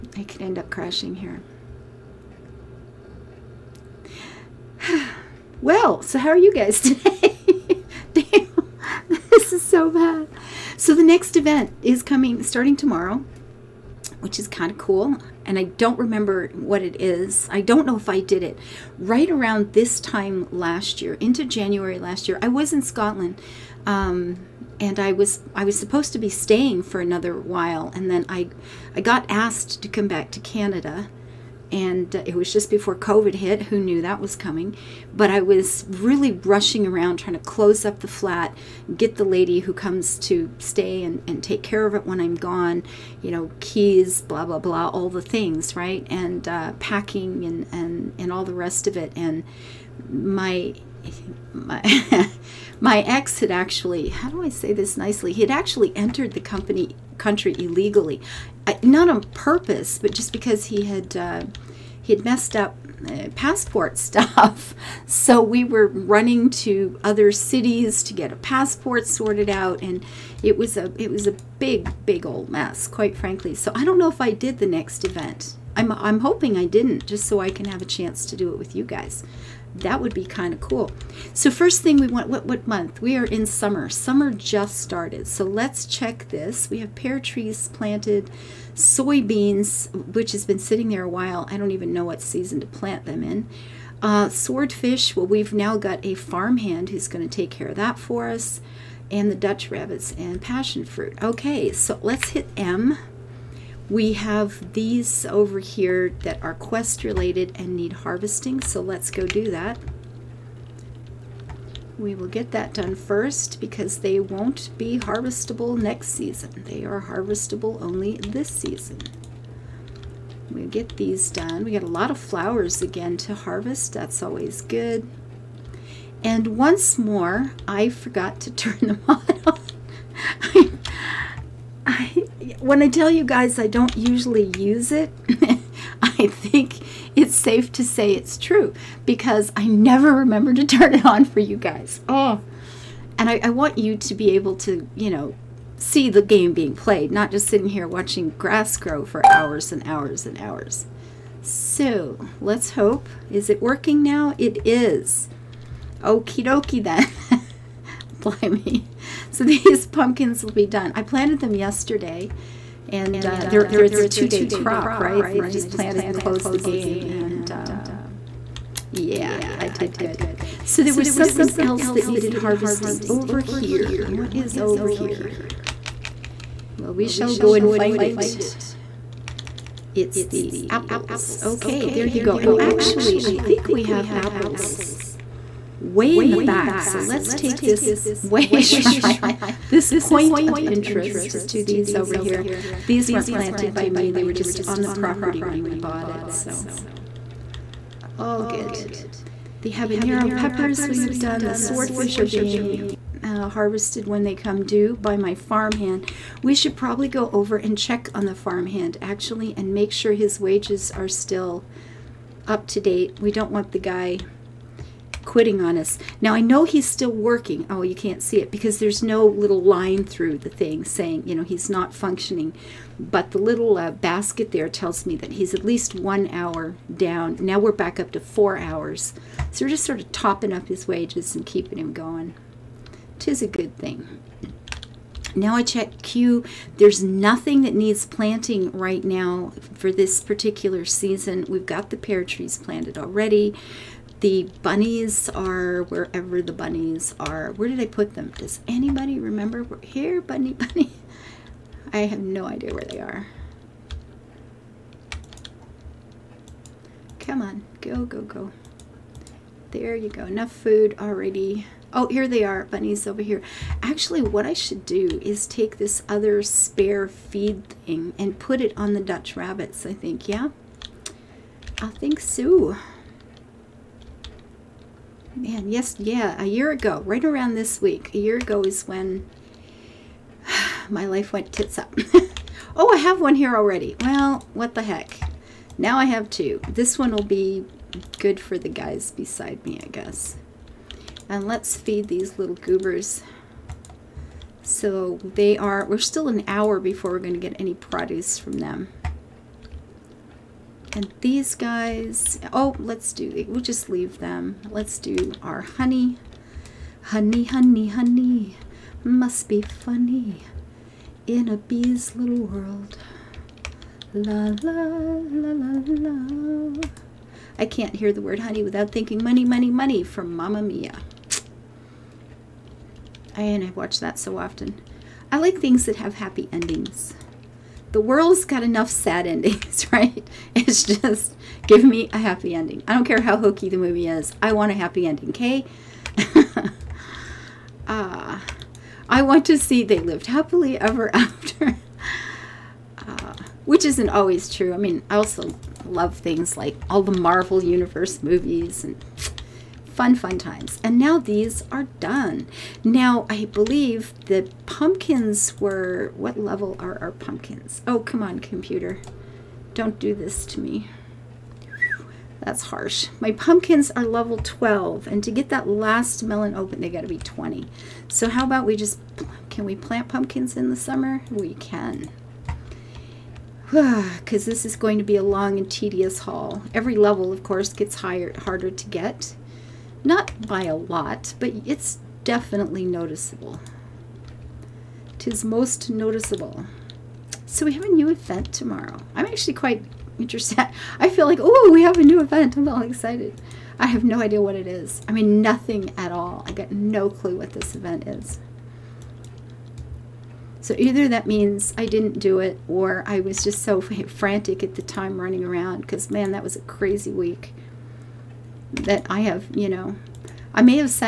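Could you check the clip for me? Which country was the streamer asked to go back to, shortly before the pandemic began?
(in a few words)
Canada.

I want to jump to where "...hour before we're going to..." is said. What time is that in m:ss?
4:56.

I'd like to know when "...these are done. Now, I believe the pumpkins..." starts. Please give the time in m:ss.
5:51.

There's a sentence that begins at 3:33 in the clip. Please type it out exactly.
We don't want the guy quitting on us.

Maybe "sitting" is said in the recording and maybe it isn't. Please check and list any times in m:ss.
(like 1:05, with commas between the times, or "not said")
1:30, 2:27.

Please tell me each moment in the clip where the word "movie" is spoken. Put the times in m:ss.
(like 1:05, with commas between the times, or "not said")
5:33, 5:48.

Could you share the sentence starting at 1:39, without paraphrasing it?
And the Dutch rabbits and passion fruit.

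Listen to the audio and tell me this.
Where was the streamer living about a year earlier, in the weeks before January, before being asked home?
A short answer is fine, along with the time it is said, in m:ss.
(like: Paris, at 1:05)
Scotland, at 0:22.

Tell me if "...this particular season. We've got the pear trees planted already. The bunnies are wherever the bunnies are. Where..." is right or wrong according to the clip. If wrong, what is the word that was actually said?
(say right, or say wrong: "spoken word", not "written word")
right.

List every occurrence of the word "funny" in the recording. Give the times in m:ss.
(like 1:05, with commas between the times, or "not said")
5:09.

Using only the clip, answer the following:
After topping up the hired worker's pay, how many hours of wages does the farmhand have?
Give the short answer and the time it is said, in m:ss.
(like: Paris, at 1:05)
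4 hours, at 3:48.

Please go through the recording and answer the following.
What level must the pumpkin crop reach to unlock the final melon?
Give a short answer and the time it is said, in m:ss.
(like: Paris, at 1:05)
20, at 6:07.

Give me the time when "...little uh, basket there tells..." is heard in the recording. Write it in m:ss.
3:43.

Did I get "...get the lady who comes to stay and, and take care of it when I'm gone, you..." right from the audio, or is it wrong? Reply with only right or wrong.
right.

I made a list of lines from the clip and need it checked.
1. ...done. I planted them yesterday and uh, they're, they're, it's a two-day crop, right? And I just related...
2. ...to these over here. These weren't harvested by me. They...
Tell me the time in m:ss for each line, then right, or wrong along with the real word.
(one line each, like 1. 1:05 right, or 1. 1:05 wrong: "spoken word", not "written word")
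1. 2:40 wrong: "planted", not "related"
2. 3:11 wrong: "planted", not "harvested".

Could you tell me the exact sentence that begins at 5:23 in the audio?
And I watch that so often.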